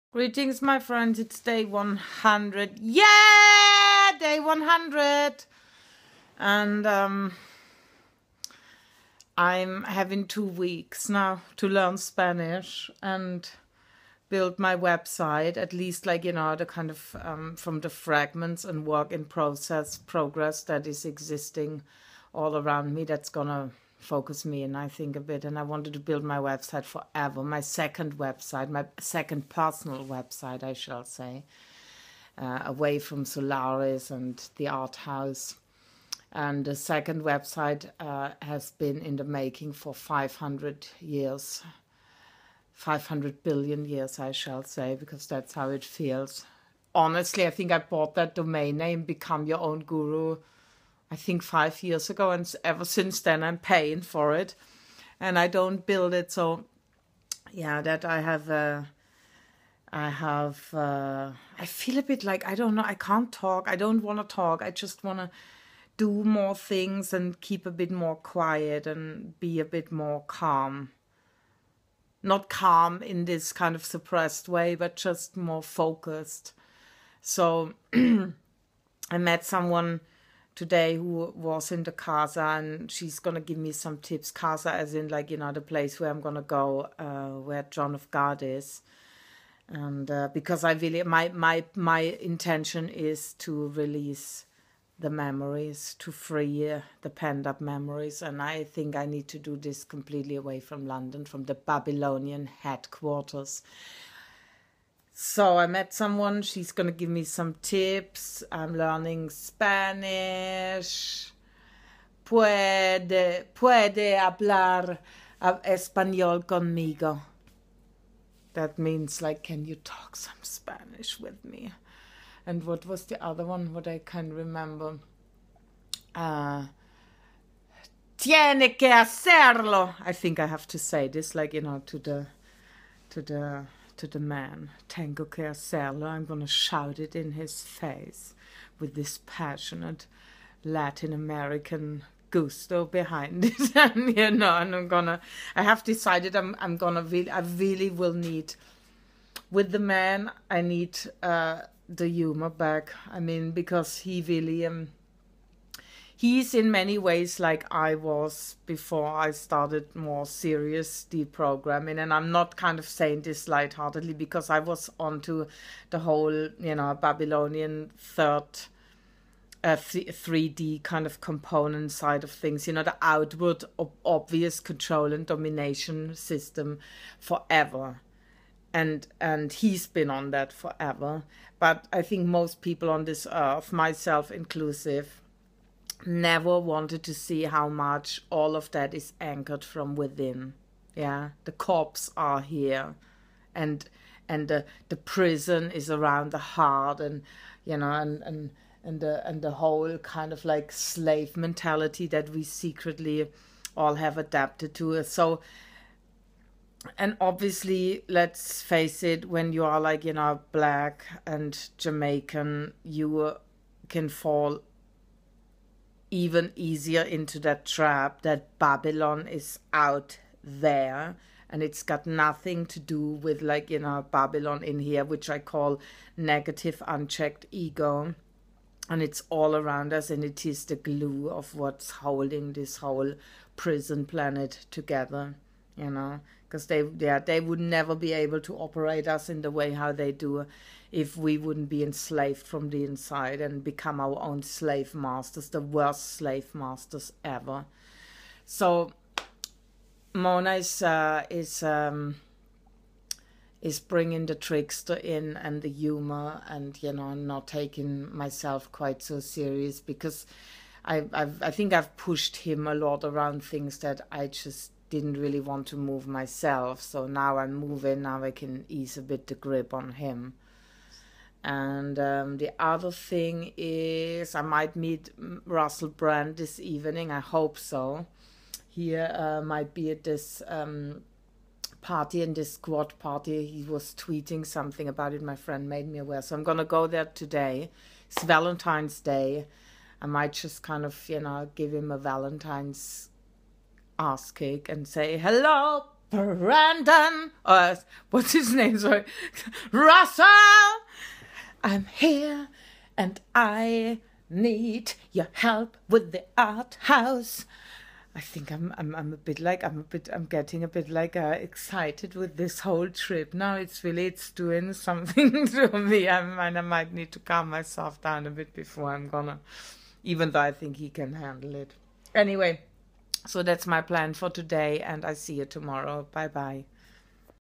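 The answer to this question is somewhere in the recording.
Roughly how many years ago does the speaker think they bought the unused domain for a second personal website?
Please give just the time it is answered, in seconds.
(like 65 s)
51 s.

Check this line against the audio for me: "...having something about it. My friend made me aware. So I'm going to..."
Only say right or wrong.
wrong.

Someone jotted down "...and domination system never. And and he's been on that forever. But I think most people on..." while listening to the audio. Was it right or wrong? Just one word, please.
wrong.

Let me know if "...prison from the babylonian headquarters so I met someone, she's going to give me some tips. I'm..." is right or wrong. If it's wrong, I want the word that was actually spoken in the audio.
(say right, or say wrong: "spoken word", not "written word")
wrong: "london", not "prison".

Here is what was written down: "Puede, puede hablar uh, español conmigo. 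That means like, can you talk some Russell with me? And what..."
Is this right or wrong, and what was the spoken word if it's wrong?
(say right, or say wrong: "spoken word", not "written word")
wrong: "Spanish", not "Russell".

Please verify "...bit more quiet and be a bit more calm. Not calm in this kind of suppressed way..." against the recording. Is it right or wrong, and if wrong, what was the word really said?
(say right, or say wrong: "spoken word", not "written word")
right.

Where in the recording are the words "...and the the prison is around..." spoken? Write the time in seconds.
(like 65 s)
194 s.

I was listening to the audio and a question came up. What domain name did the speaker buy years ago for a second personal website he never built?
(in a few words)
Become your own guru.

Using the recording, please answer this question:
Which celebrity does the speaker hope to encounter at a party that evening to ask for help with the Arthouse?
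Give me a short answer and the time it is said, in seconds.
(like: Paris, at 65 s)
Russell Brand, at 275 s.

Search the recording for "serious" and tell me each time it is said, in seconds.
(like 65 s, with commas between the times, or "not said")
160 s, 259 s.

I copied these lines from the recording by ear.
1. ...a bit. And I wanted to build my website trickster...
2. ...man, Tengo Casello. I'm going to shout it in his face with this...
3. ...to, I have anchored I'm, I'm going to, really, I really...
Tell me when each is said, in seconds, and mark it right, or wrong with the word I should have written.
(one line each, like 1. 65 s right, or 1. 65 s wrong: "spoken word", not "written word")
1. 25 s wrong: "forever", not "trickster"
2. 134 s right
3. 145 s wrong: "decided", not "anchored".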